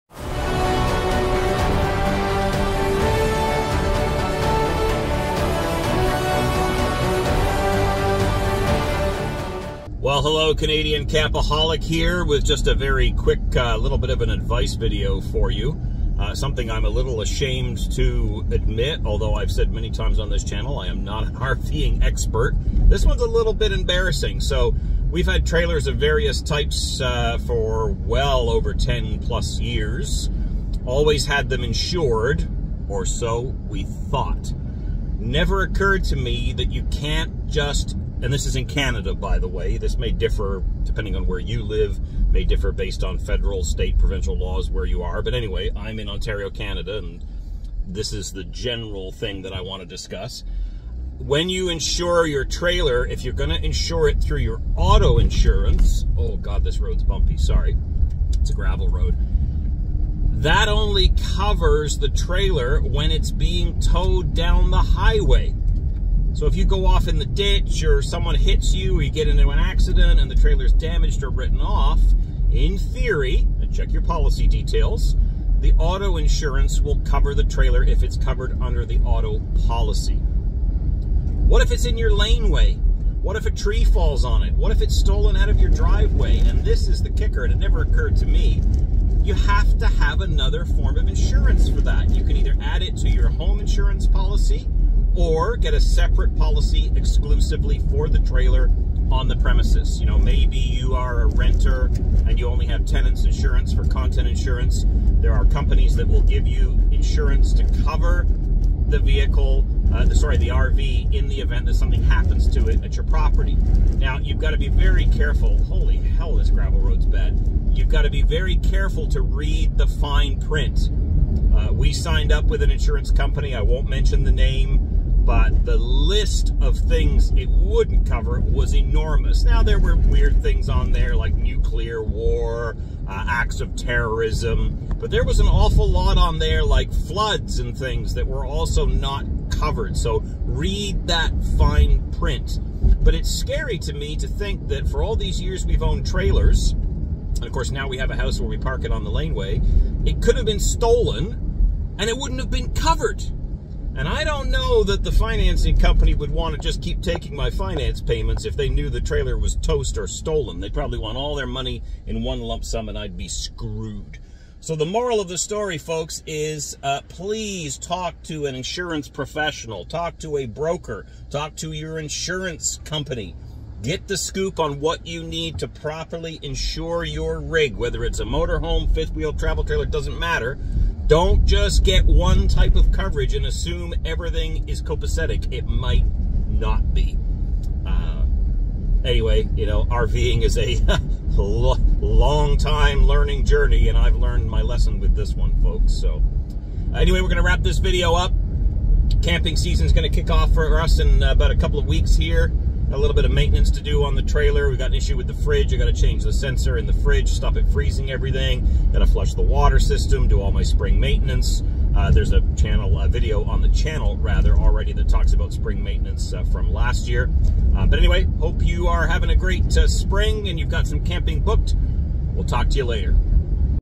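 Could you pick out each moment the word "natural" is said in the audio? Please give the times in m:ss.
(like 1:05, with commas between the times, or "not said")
not said.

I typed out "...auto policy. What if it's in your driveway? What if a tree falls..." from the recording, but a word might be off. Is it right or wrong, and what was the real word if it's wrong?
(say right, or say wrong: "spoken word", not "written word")
wrong: "laneway", not "driveway".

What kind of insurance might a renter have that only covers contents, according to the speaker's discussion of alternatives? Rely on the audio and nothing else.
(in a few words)
Tenants insurance.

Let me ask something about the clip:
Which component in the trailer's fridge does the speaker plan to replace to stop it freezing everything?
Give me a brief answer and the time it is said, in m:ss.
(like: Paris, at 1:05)
Sensor, at 3:26.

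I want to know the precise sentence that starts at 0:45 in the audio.
But anyway, I'm in Ontario, Canada, and this is the general thing that I want to discuss.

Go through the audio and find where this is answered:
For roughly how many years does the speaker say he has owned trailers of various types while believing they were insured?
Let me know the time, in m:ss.
0:28.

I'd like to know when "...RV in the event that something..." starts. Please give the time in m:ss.
1:50.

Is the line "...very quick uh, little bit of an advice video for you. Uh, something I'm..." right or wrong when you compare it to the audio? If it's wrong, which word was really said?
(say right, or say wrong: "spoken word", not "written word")
right.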